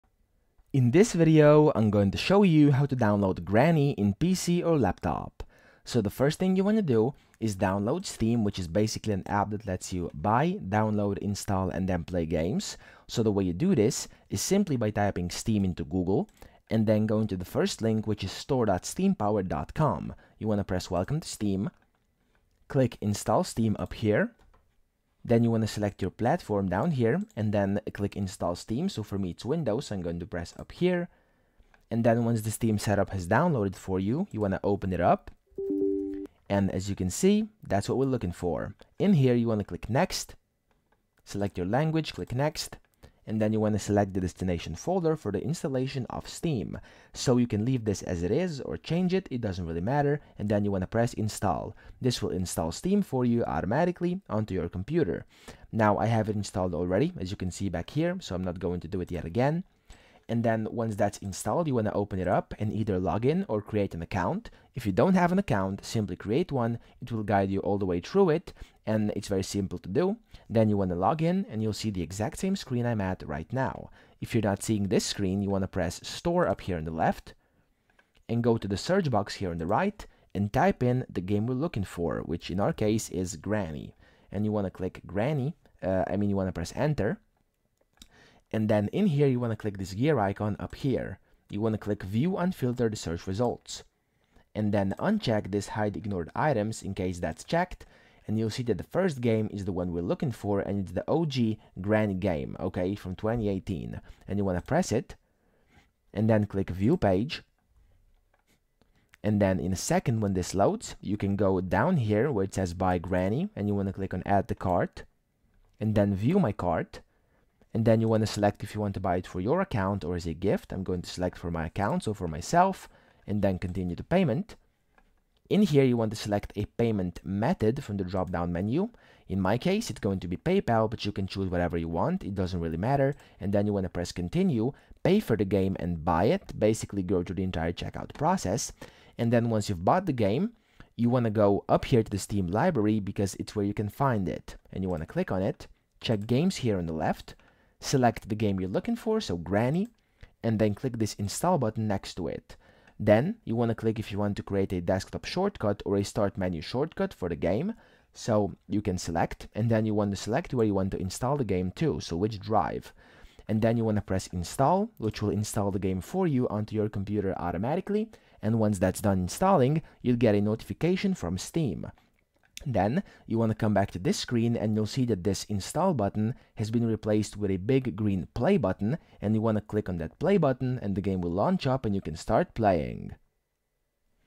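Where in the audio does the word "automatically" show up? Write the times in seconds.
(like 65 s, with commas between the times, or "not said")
53 s, 167 s.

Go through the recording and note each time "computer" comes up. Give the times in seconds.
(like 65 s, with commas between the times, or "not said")
54 s, 166 s.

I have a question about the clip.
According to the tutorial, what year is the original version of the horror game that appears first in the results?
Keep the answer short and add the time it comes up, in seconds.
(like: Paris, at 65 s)
2018, at 103 s.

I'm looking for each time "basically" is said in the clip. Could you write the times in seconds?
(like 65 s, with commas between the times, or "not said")
8 s, 136 s.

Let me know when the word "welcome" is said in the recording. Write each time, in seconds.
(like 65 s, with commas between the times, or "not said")
20 s.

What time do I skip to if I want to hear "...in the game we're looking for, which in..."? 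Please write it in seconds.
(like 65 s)
80 s.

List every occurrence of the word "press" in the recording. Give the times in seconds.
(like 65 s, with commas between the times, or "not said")
20 s, 30 s, 50 s, 75 s, 86 s, 104 s, 133 s, 164 s.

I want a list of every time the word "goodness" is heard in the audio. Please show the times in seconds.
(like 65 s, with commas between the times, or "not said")
not said.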